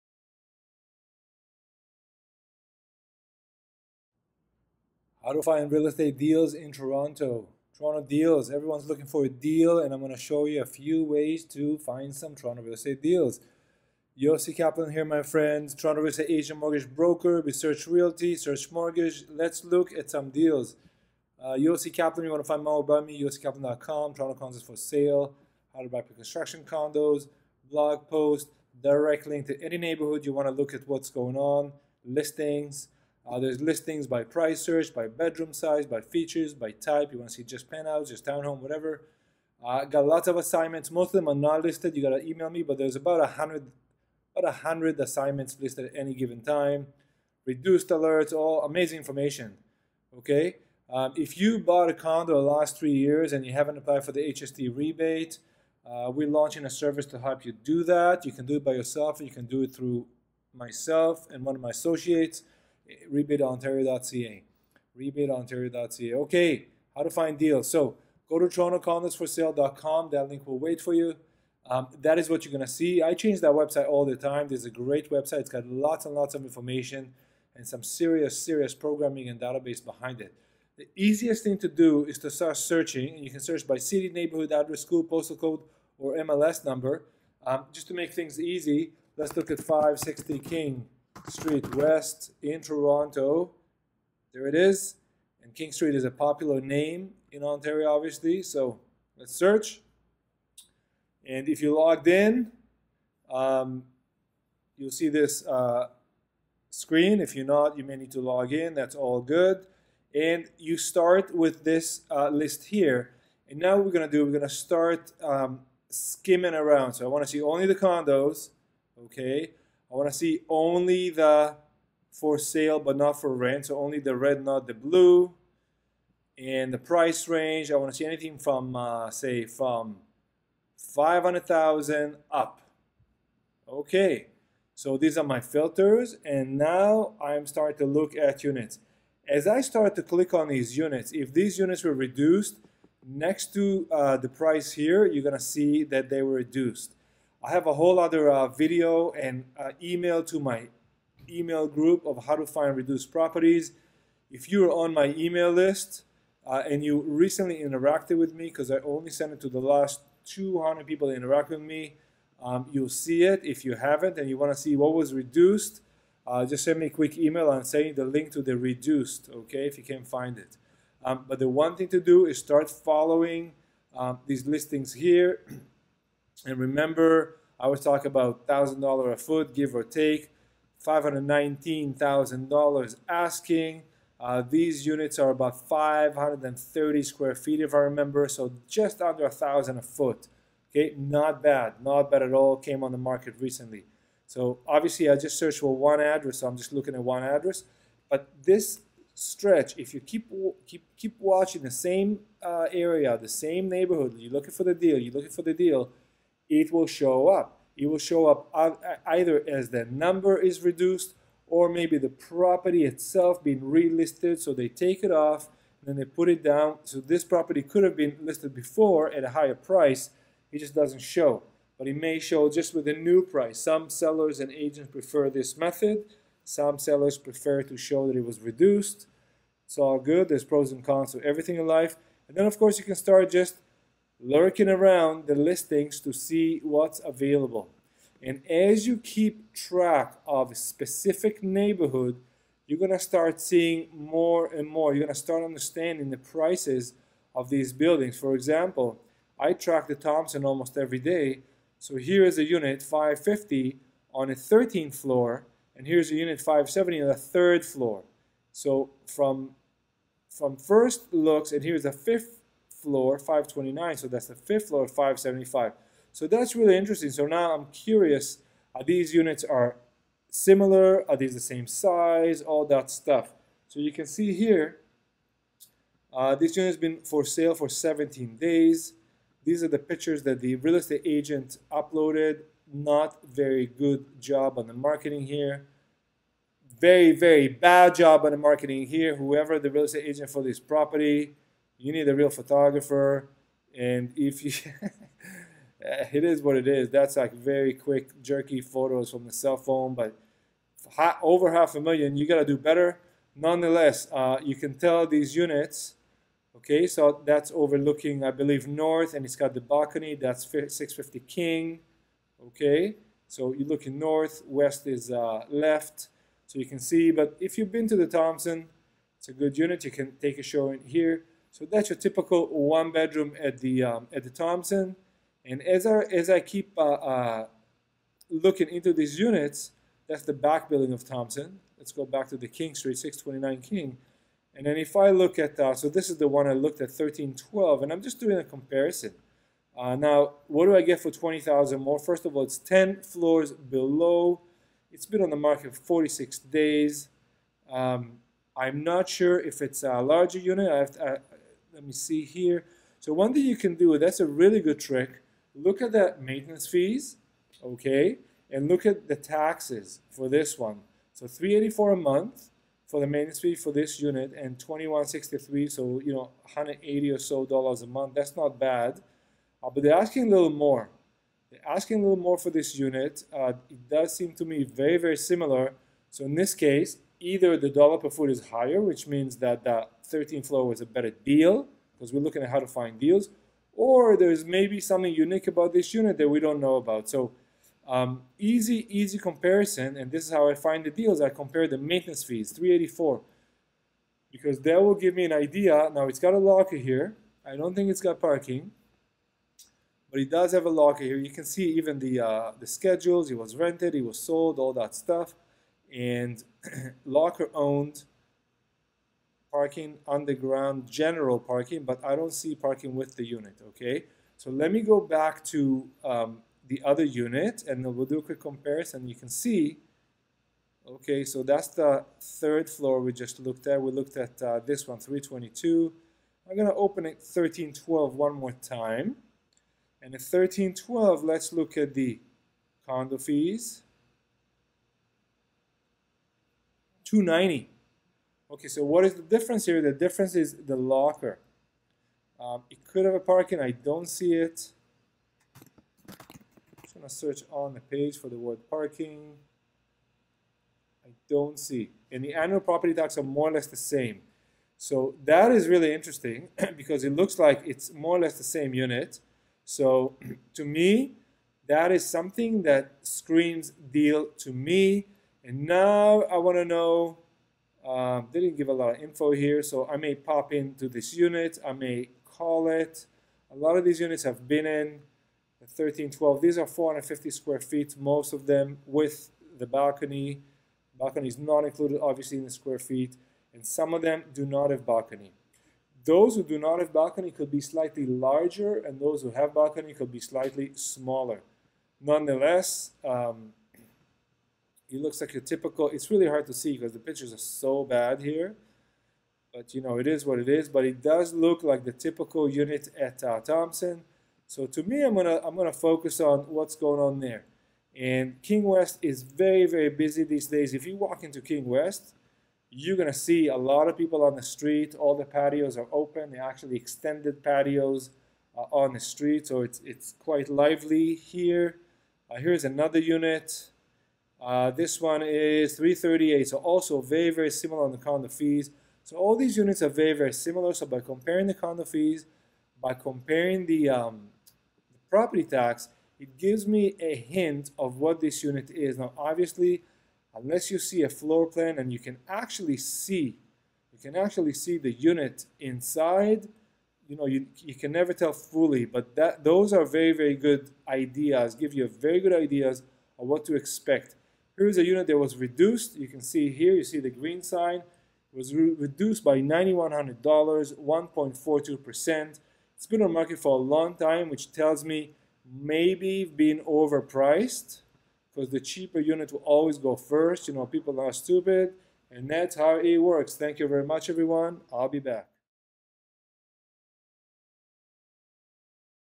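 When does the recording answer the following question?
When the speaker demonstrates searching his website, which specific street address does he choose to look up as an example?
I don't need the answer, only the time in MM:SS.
01:29.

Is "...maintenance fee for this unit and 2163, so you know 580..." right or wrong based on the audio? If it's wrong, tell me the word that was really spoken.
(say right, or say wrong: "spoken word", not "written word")
wrong: "180", not "580".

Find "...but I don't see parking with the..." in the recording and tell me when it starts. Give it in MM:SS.
06:51.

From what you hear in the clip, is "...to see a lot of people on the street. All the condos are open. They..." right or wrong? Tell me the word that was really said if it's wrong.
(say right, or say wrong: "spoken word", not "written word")
wrong: "patios", not "condos".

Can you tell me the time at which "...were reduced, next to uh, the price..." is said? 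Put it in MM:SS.
02:21.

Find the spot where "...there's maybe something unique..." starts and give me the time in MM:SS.
06:24.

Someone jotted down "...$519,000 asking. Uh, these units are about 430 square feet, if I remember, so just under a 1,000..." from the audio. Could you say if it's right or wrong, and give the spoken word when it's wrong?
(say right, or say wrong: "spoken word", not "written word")
wrong: "530", not "430".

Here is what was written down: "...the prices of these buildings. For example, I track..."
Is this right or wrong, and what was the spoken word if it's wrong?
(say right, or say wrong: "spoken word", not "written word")
right.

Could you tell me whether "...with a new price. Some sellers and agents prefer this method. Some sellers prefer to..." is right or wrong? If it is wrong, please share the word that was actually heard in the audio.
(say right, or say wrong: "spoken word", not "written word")
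right.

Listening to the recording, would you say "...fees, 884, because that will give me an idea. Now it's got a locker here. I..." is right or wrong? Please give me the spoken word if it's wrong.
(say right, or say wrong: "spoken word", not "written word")
wrong: "384", not "884".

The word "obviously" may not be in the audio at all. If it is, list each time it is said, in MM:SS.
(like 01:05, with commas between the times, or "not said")
01:37, 03:14, 08:02, 08:59.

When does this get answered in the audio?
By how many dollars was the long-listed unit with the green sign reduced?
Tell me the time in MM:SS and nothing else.
09:19.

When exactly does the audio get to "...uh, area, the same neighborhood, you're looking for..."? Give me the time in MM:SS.
03:22.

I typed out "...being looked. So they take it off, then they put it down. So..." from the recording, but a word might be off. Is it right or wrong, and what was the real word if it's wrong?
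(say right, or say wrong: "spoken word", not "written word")
wrong: "relisted", not "looked".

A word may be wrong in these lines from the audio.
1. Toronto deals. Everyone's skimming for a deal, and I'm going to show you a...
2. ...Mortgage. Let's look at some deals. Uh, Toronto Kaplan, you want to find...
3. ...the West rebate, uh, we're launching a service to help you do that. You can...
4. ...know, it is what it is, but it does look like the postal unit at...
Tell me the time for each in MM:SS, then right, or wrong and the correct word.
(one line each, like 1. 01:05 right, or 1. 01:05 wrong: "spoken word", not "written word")
1. 00:07 wrong: "looking", not "skimming"
2. 00:18 wrong: "Yossi", not "Toronto"
3. 00:54 wrong: "HST", not "West"
4. 08:19 wrong: "typical", not "postal".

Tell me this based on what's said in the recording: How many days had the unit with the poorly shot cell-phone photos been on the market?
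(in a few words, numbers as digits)
17 days.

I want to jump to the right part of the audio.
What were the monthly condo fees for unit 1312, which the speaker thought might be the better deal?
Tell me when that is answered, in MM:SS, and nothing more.
07:17.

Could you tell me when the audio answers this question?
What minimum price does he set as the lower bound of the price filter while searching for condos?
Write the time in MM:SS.
02:10.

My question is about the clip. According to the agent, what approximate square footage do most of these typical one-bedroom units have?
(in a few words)
450 square feet.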